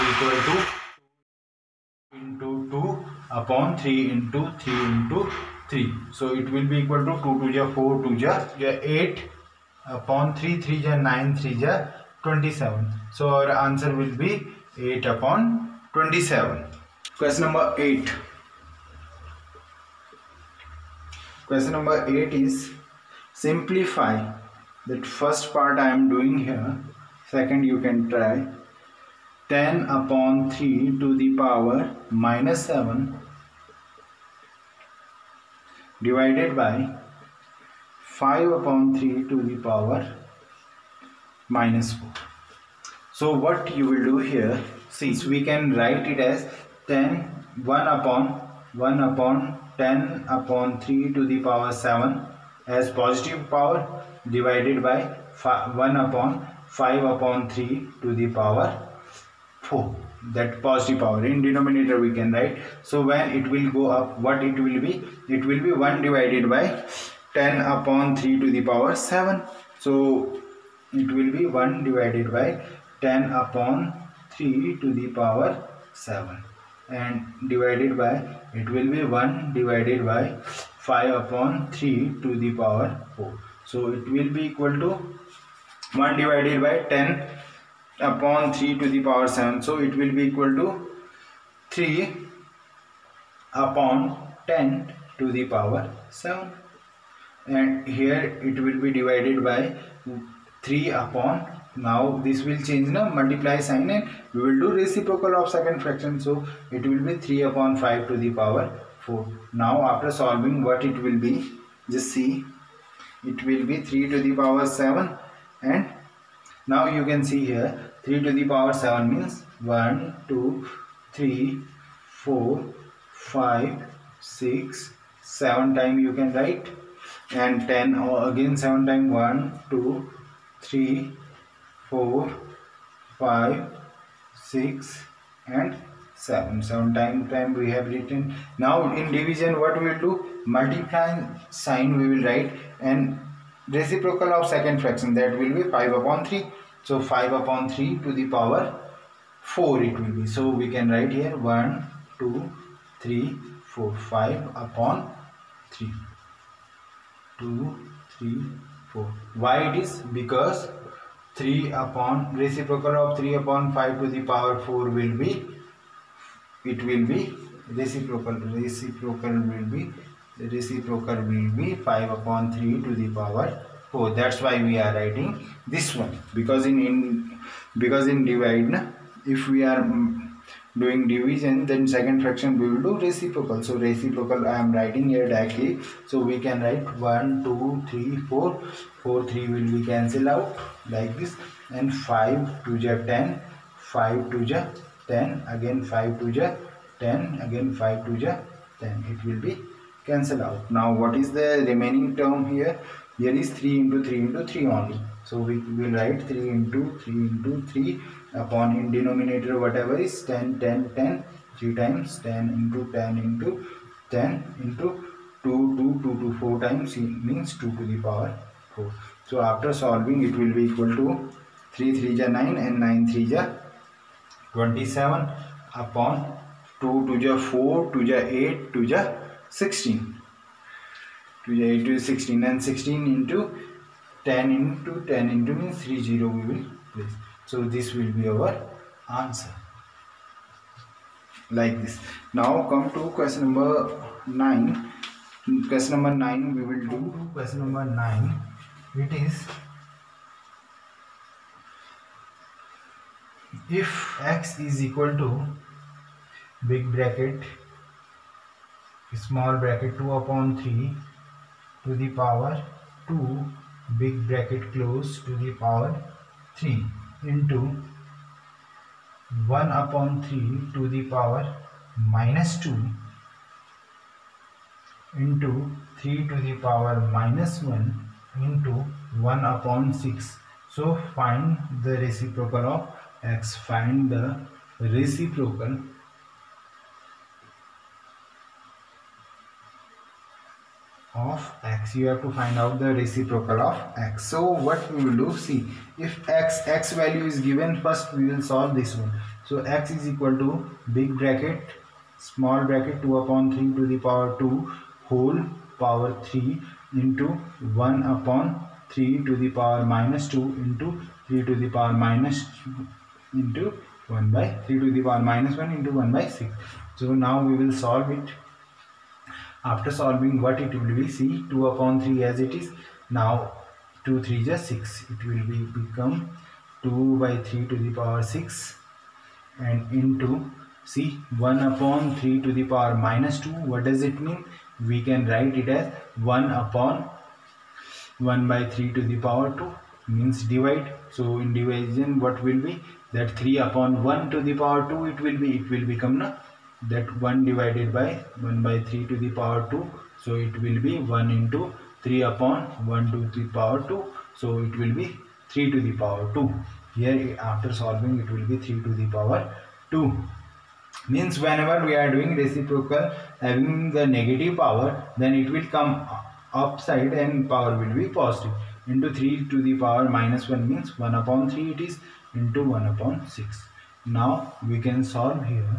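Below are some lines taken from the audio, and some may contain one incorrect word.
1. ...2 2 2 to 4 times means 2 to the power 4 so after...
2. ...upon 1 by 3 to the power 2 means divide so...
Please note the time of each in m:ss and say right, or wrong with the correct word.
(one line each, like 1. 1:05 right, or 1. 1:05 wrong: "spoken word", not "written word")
1. 3:35 right
2. 5:36 right.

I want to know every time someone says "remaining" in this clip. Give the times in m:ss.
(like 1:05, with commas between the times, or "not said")
3:21.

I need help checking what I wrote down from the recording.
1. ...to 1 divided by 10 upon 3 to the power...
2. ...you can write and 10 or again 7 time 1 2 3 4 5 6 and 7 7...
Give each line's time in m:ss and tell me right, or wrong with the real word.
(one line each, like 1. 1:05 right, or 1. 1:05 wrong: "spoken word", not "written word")
1. 1:24 right
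2. 2:06 right.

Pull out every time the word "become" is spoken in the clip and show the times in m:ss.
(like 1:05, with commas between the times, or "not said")
5:25, 5:45.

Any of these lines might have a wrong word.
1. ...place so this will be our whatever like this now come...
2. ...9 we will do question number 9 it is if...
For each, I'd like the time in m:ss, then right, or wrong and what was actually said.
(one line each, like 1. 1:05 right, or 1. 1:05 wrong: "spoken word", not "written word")
1. 3:56 wrong: "answer", not "whatever"
2. 4:06 right.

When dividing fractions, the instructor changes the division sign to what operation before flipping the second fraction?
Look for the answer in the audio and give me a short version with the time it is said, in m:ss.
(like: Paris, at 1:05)
multiply, at 1:43.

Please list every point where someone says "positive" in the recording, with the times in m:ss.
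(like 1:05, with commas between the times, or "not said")
0:52, 1:00, 6:08.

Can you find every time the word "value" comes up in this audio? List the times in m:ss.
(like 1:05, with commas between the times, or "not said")
4:56.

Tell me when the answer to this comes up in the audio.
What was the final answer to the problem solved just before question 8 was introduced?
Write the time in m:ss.
0:14.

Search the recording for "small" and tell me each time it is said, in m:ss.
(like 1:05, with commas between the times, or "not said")
4:19, 5:02.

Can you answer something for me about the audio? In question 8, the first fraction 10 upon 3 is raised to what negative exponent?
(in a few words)
-7.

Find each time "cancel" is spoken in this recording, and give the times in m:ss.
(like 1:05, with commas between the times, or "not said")
3:09, 3:20.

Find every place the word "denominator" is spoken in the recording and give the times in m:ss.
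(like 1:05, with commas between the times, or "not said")
1:01, 3:28.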